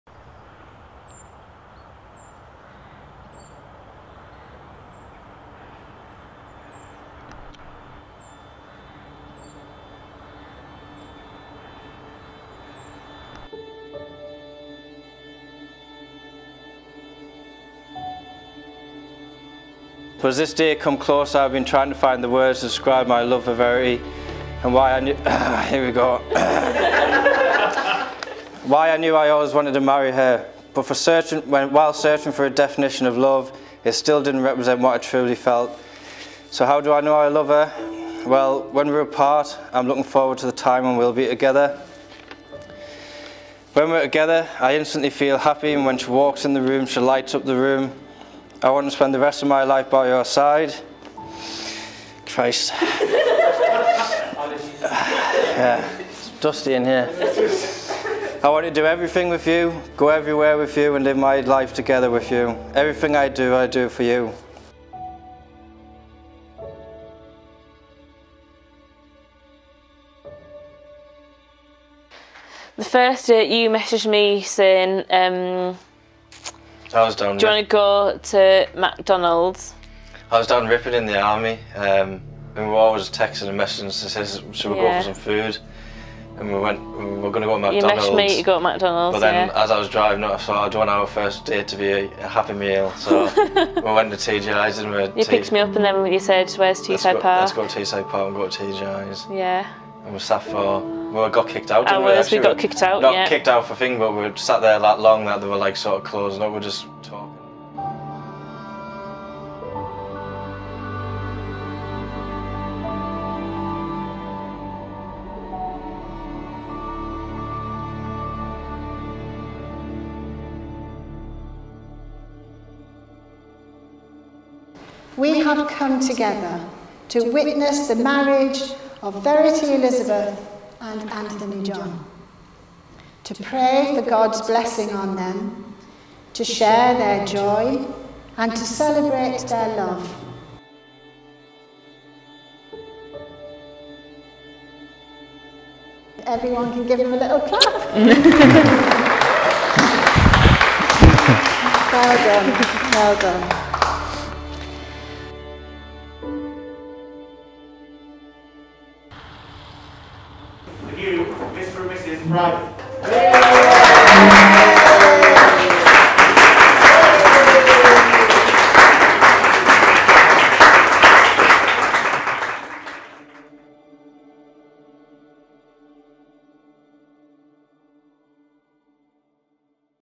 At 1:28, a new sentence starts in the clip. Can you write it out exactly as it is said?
messaged me to go to McDonald's.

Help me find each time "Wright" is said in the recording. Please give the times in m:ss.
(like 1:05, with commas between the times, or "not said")
2:44.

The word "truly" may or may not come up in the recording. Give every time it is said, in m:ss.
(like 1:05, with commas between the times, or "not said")
0:34.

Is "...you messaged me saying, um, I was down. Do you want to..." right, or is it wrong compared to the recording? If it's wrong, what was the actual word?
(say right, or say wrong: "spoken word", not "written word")
right.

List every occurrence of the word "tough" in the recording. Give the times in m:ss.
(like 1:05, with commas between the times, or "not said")
not said.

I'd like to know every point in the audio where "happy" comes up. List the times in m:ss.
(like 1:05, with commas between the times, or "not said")
0:45, 1:32.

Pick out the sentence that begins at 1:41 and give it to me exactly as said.
Hours, we, we got kicked out.